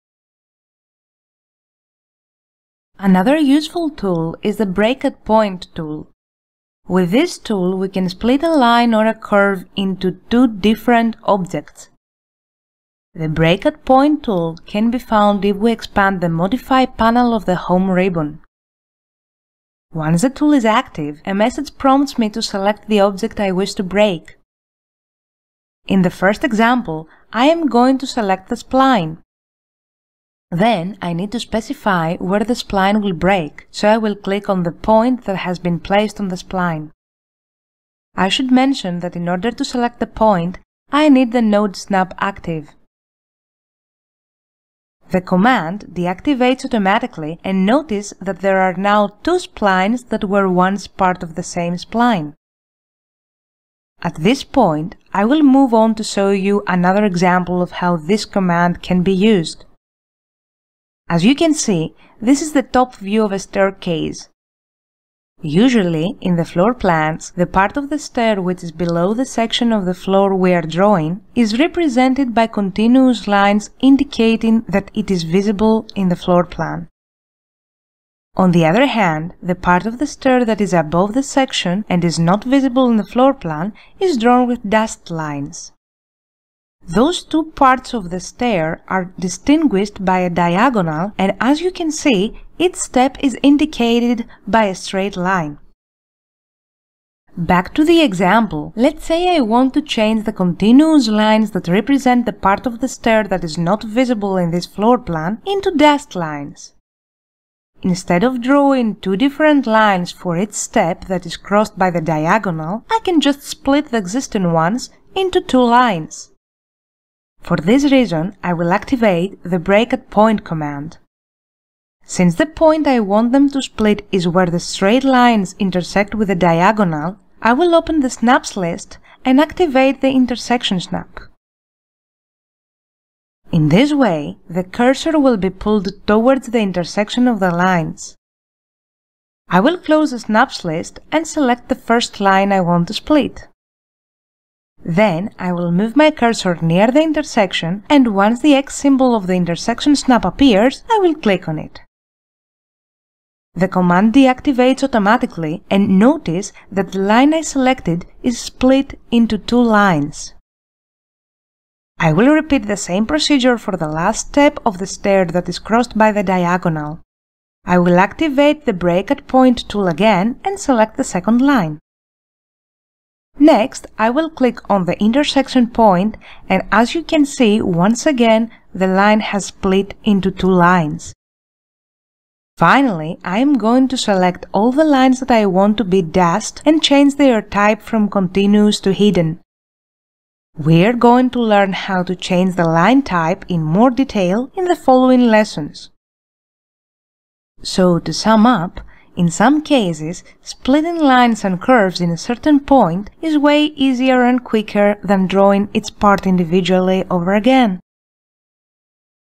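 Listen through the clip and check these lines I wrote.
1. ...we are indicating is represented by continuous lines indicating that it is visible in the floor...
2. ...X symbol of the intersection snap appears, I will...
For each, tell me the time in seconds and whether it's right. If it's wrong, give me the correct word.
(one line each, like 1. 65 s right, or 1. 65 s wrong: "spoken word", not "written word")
1. 70 s wrong: "drawing", not "indicating"
2. 148 s right.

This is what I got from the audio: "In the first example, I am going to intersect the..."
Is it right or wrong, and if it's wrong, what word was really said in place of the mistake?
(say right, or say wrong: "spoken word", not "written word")
wrong: "select", not "intersect".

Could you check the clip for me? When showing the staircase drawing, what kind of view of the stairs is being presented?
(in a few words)
Top view.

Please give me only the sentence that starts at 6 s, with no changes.
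With this tool we can split a line or a curve into two different objects.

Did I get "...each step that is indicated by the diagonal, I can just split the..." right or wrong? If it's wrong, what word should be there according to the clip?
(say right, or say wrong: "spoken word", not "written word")
wrong: "crossed", not "indicated".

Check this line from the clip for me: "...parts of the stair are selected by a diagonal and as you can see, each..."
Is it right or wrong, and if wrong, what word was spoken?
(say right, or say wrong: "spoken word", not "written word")
wrong: "distinguished", not "selected".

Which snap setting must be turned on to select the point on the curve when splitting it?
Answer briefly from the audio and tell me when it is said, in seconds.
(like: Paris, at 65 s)
Node snap, at 41 s.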